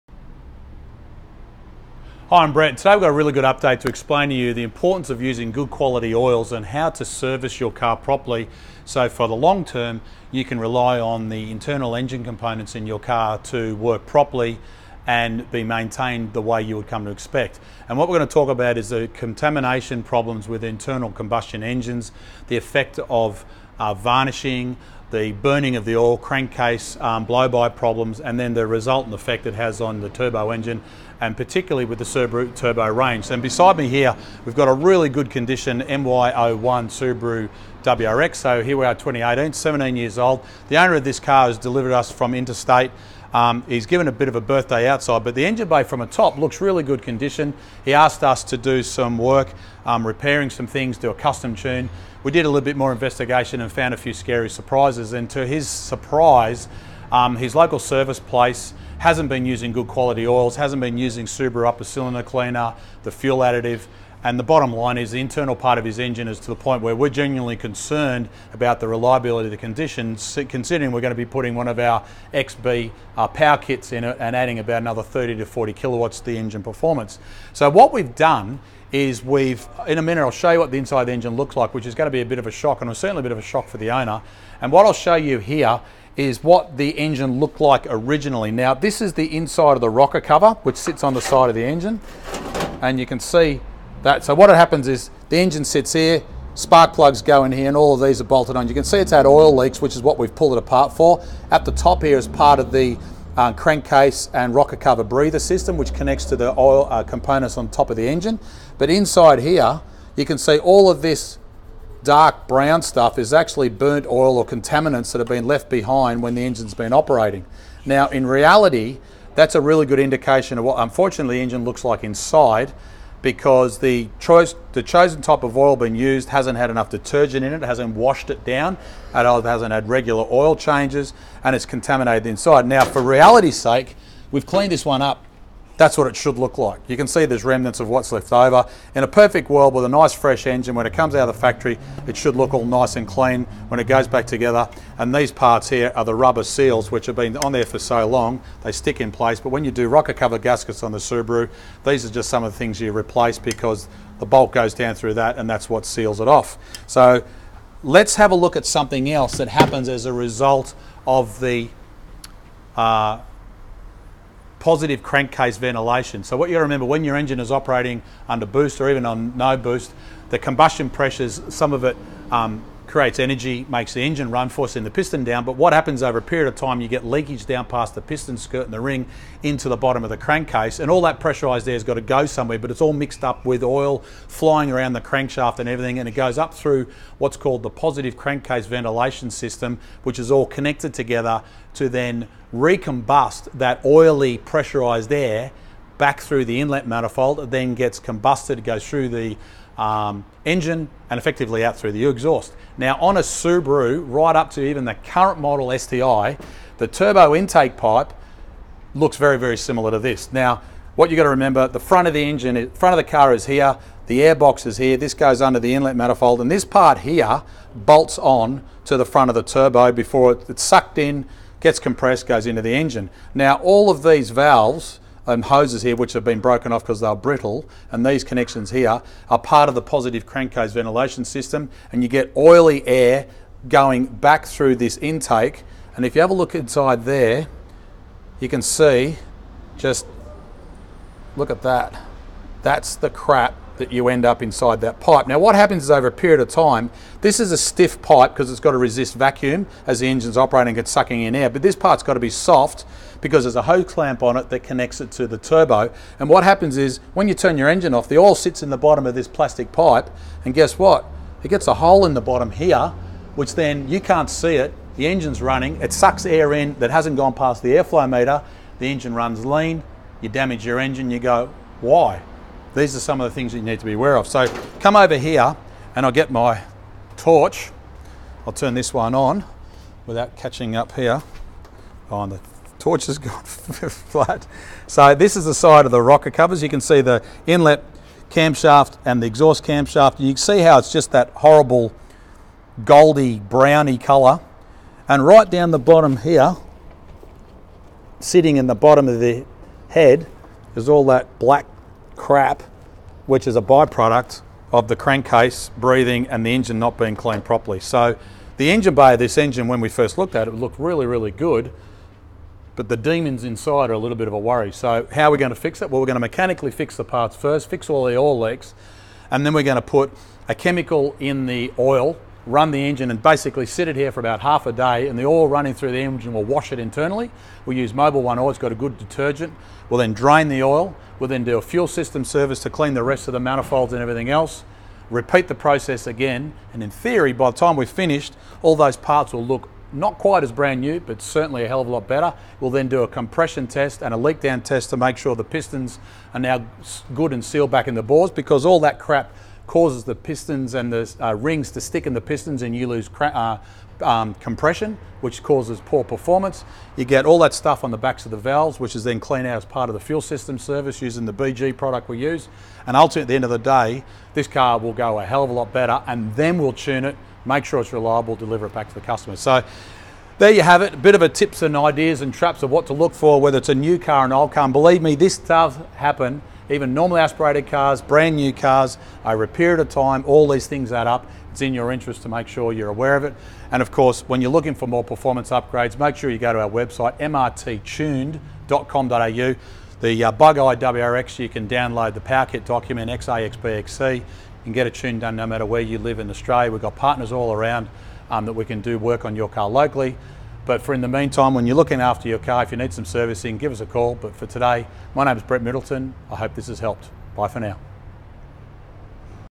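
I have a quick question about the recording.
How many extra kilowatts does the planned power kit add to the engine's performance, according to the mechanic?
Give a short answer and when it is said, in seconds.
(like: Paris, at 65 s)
30 to 40, at 75 s.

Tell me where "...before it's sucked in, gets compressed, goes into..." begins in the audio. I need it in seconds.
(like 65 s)
219 s.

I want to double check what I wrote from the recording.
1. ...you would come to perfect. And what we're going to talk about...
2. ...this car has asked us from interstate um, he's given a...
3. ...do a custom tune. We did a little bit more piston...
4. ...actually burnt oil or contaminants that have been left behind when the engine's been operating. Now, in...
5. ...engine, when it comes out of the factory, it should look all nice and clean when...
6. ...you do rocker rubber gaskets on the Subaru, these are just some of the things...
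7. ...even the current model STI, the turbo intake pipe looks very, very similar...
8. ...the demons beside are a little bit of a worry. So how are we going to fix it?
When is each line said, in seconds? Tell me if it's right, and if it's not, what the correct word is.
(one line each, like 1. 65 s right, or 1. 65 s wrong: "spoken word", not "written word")
1. 16 s wrong: "expect", not "perfect"
2. 41 s wrong: "delivered", not "asked"
3. 50 s wrong: "investigation", not "piston"
4. 113 s right
5. 140 s right
6. 149 s wrong: "cover", not "rubber"
7. 204 s right
8. 312 s wrong: "inside", not "beside".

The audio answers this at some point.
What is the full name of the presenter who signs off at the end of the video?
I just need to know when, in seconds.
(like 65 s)
405 s.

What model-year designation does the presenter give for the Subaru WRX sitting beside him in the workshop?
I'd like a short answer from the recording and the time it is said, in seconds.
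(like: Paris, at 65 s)
MY01, at 35 s.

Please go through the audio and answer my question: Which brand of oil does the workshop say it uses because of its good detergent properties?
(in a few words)
Mobil One.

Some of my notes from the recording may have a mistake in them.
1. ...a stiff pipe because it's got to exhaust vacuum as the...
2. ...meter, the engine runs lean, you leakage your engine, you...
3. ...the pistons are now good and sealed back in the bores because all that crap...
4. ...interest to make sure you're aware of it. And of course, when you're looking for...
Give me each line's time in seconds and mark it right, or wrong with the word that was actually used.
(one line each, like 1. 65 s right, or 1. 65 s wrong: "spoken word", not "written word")
1. 247 s wrong: "resist", not "exhaust"
2. 268 s wrong: "damage", not "leakage"
3. 345 s right
4. 381 s right.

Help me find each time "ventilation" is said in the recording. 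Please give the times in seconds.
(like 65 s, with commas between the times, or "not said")
165 s, 188 s, 230 s.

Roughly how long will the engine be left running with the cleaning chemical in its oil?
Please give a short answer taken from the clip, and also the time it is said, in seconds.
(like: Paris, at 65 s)
half a day, at 324 s.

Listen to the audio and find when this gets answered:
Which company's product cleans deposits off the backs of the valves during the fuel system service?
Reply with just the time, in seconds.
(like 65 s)
361 s.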